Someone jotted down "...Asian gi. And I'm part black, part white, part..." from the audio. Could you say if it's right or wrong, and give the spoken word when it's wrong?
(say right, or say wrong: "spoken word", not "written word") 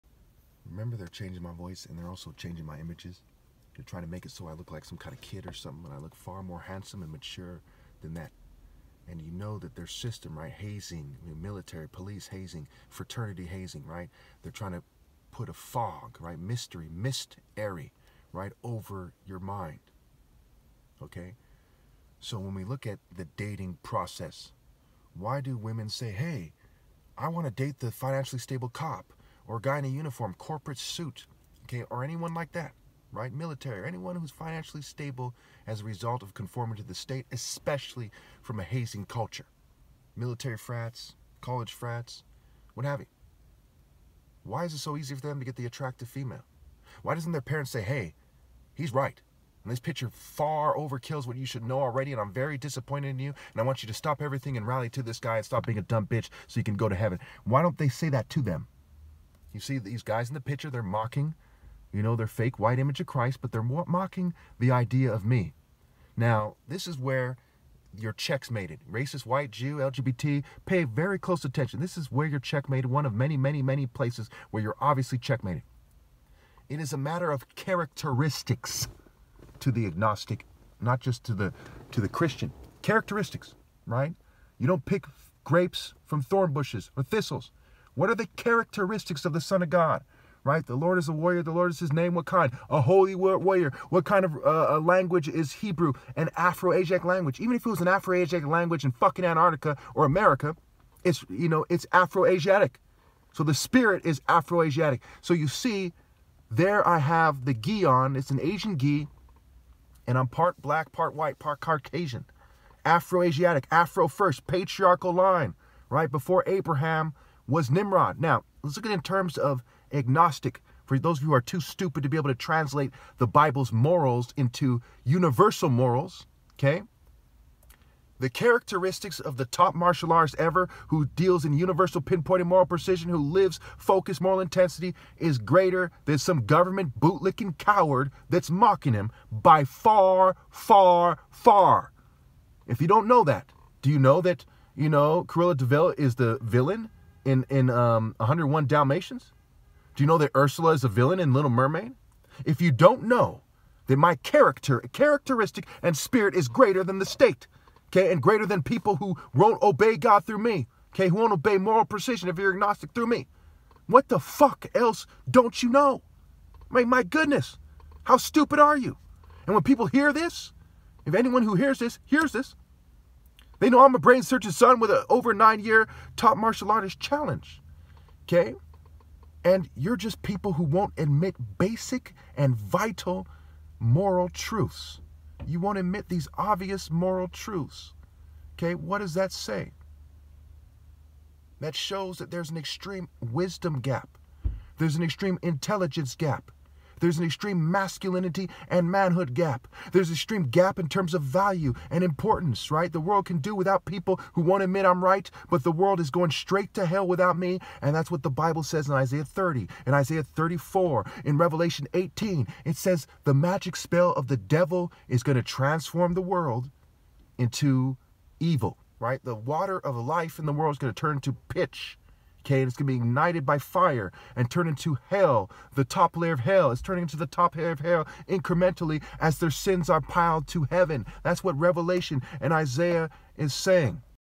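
right.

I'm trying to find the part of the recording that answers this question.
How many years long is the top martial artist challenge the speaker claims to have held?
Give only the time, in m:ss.
2:55.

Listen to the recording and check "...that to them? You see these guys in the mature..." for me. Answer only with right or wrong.
wrong.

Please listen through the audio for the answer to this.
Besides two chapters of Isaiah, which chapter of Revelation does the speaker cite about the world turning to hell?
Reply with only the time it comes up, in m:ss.
3:31.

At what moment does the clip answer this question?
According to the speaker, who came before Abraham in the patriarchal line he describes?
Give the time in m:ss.
1:57.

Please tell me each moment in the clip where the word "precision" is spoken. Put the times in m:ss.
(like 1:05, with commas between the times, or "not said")
2:12, 2:41.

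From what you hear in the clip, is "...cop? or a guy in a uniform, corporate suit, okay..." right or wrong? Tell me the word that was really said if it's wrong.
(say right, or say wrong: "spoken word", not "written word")
right.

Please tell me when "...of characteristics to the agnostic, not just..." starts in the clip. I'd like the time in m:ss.
1:17.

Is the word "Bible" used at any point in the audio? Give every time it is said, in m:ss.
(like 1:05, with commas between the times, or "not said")
2:03, 3:28.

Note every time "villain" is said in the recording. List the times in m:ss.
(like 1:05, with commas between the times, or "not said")
2:26, 2:30.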